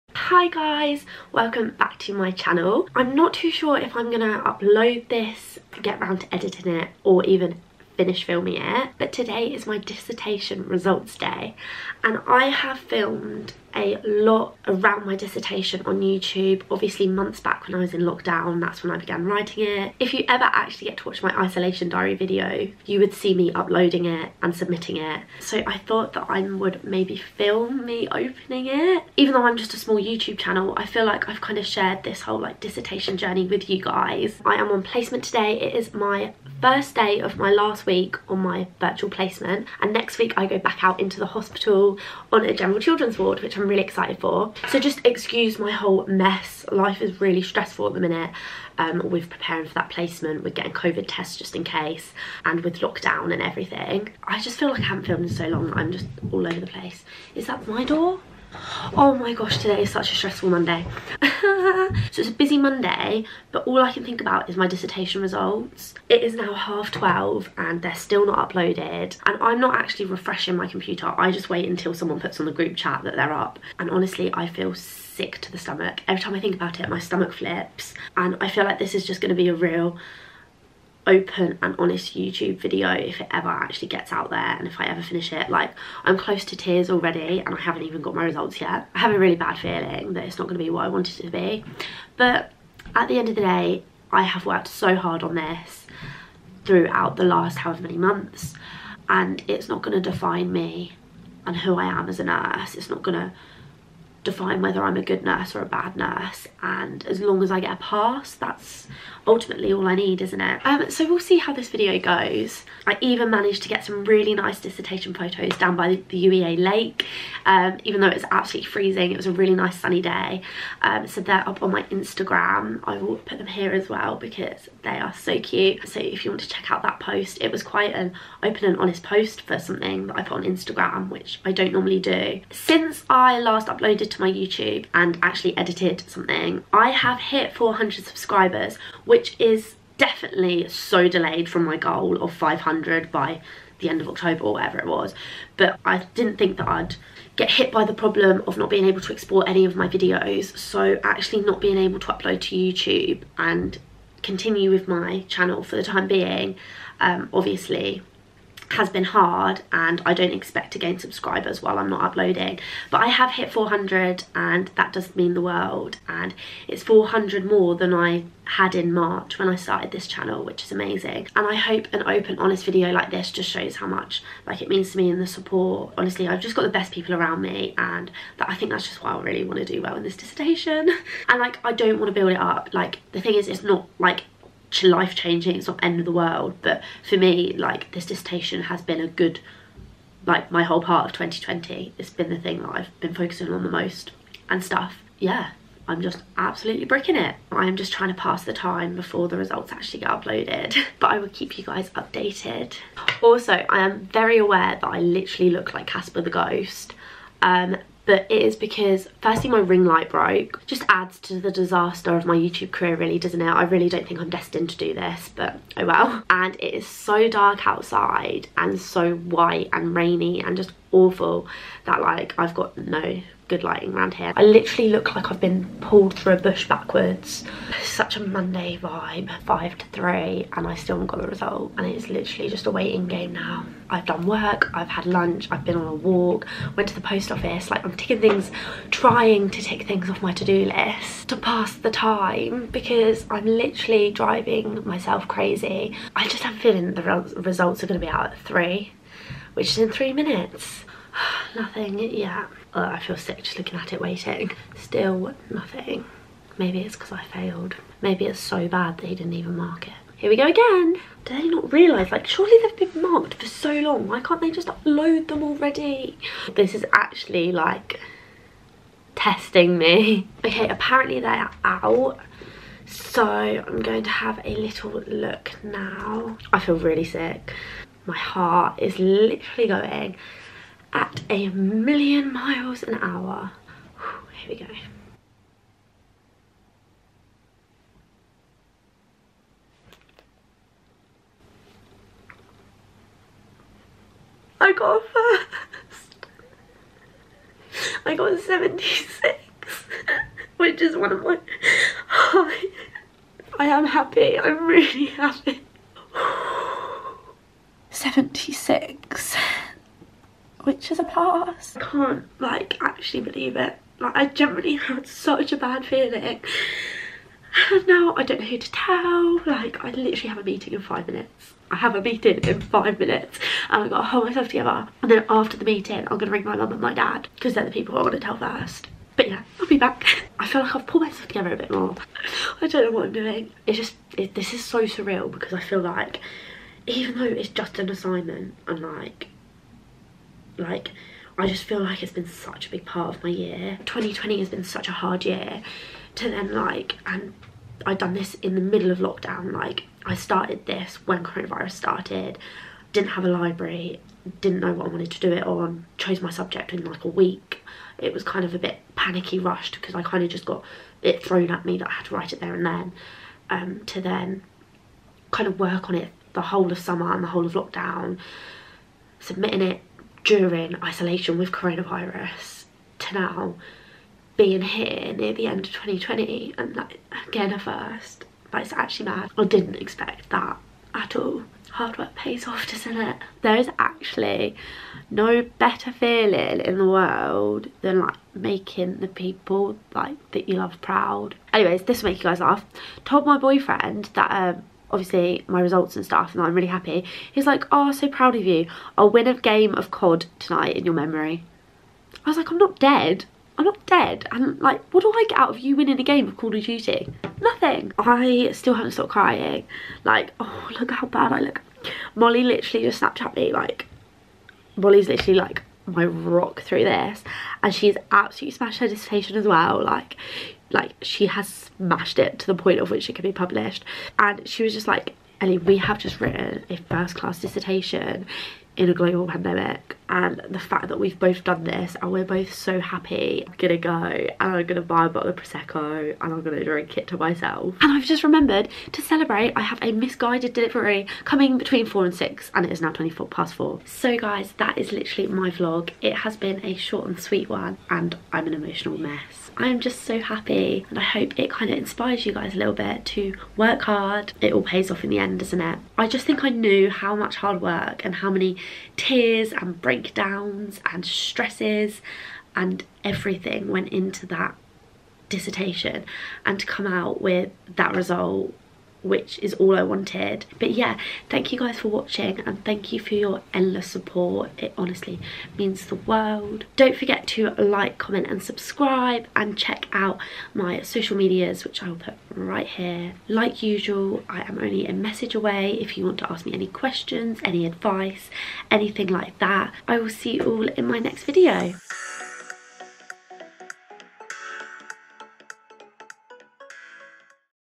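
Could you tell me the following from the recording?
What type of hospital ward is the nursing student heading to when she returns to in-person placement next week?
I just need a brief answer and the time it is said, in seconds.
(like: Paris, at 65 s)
General children's ward, at 42 s.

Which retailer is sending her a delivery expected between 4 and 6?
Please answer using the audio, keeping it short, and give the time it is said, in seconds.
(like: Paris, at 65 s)
Missguided, at 439 s.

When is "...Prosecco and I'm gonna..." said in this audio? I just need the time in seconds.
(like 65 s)
435 s.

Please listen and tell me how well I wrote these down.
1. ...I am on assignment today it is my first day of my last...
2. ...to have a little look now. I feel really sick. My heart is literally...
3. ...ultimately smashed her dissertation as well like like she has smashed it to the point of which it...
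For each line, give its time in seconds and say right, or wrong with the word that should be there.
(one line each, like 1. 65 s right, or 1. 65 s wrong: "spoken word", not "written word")
1. 34 s wrong: "placement", not "assignment"
2. 274 s right
3. 418 s wrong: "absolutely", not "ultimately".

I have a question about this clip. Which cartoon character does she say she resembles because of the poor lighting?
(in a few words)
Casper the Ghost.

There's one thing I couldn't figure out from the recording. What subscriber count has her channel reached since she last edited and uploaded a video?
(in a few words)
400.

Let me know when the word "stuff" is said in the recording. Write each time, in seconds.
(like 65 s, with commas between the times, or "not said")
194 s, 396 s.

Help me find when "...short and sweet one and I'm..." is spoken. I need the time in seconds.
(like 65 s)
446 s.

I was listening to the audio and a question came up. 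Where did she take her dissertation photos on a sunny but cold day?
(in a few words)
UEA lake.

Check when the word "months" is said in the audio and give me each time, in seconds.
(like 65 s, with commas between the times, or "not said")
17 s, 97 s.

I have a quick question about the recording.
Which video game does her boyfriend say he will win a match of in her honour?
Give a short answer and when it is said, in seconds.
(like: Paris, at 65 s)
Call of Duty, at 406 s.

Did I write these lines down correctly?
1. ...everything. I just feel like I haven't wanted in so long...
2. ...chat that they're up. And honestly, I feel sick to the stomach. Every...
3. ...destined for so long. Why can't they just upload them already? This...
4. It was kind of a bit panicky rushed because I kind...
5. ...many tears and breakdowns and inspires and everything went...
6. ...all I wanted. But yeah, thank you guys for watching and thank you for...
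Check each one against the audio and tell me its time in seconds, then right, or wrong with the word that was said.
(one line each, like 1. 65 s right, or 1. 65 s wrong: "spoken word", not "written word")
1. 53 s wrong: "filmed", not "wanted"
2. 72 s right
3. 263 s wrong: "marked", not "destined"
4. 357 s right
5. 458 s wrong: "stresses", not "inspires"
6. 469 s right.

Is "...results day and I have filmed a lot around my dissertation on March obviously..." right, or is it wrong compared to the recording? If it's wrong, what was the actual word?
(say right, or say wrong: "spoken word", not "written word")
wrong: "YouTube", not "March".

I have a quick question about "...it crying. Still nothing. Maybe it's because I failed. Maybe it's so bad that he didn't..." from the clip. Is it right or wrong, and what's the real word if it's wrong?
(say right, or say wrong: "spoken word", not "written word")
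wrong: "waiting", not "crying".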